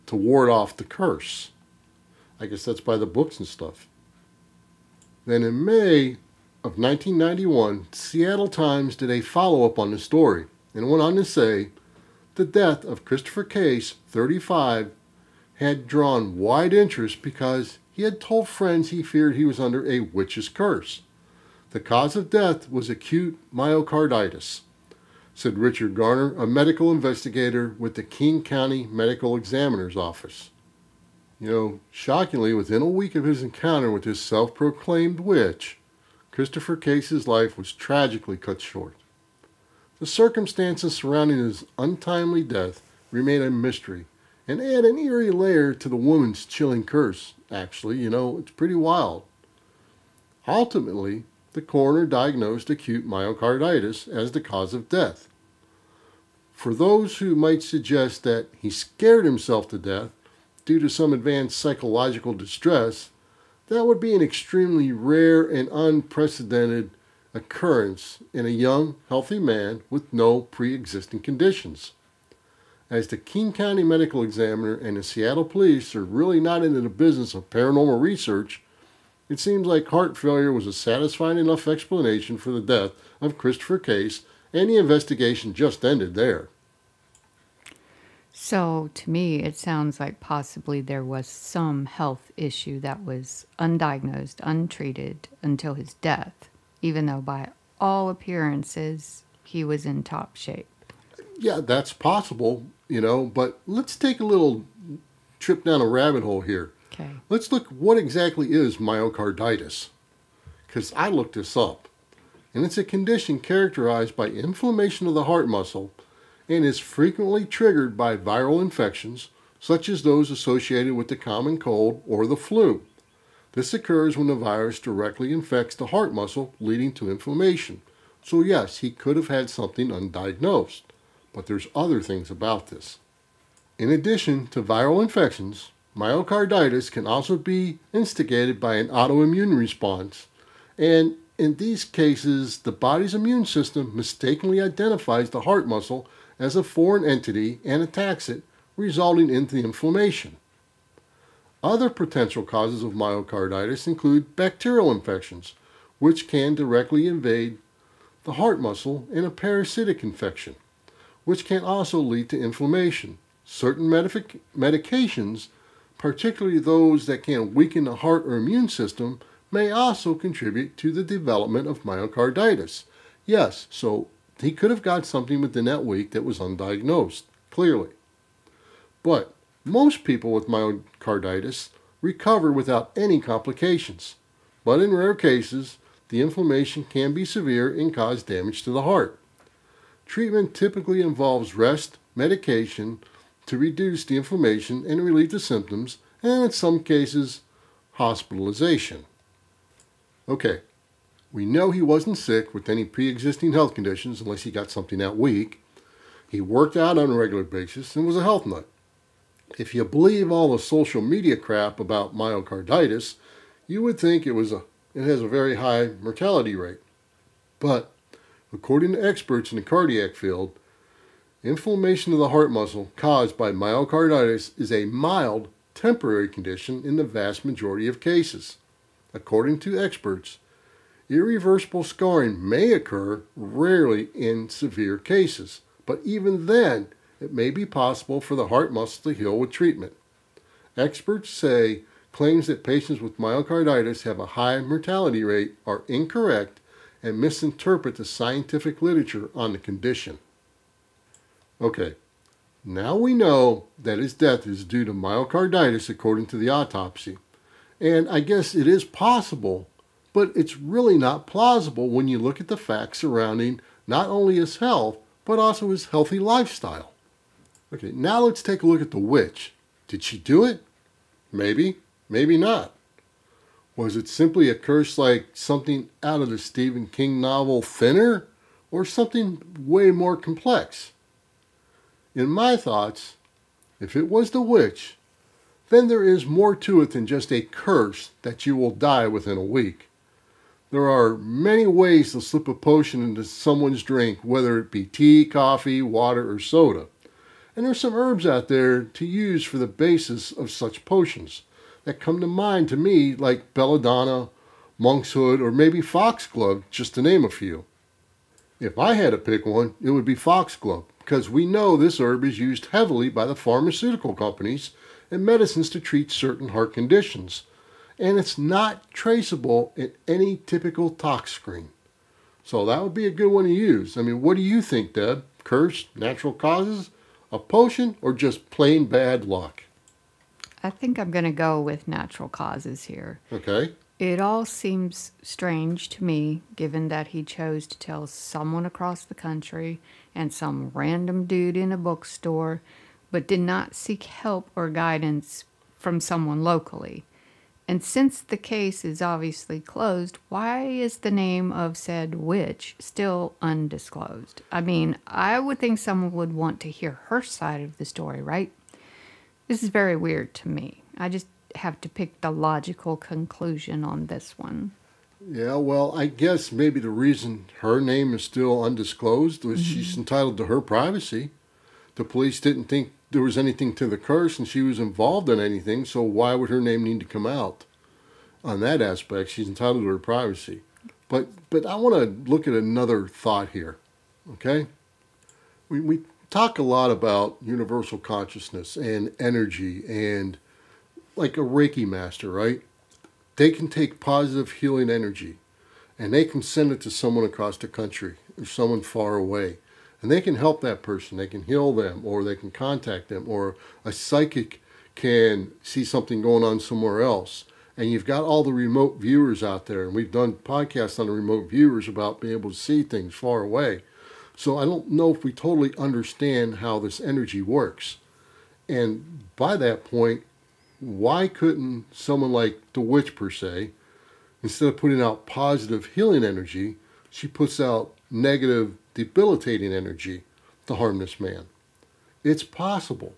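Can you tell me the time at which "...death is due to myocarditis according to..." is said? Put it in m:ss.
4:14.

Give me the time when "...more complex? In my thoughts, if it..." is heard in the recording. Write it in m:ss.
4:39.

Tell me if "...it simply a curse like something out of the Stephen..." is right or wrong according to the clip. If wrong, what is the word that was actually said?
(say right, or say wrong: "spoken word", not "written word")
right.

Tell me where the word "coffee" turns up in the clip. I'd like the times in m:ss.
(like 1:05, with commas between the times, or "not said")
4:55.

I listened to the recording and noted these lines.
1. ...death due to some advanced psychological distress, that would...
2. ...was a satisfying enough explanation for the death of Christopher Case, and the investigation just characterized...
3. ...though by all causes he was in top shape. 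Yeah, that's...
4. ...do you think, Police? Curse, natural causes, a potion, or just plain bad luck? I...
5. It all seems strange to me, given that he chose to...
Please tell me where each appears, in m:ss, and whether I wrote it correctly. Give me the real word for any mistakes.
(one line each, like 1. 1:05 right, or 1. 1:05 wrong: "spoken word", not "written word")
1. 0:59 right
2. 1:20 wrong: "ended", not "characterized"
3. 1:37 wrong: "appearances", not "causes"
4. 5:24 wrong: "Deb", not "Police"
5. 5:33 right.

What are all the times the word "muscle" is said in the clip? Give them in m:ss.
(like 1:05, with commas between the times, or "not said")
1:55, 2:06, 2:25, 2:38, 3:42, 3:58.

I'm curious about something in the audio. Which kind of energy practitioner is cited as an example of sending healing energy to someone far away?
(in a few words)
Reiki master.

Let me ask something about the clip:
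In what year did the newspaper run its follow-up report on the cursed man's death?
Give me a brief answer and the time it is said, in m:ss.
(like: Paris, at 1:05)
1991, at 0:06.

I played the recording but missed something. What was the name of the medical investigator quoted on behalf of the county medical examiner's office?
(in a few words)
Richard Garner.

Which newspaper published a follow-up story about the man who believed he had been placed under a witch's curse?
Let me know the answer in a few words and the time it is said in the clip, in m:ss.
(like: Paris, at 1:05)
Seattle Times, at 0:07.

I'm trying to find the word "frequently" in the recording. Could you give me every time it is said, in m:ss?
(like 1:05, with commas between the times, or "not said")
1:56.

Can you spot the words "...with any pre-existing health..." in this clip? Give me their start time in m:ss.
3:22.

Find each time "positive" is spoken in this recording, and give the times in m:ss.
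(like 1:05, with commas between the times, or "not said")
6:34, 7:05.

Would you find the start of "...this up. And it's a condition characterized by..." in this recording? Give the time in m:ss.
1:51.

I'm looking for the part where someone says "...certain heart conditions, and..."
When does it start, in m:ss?
5:16.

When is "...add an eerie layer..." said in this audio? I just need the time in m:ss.
0:44.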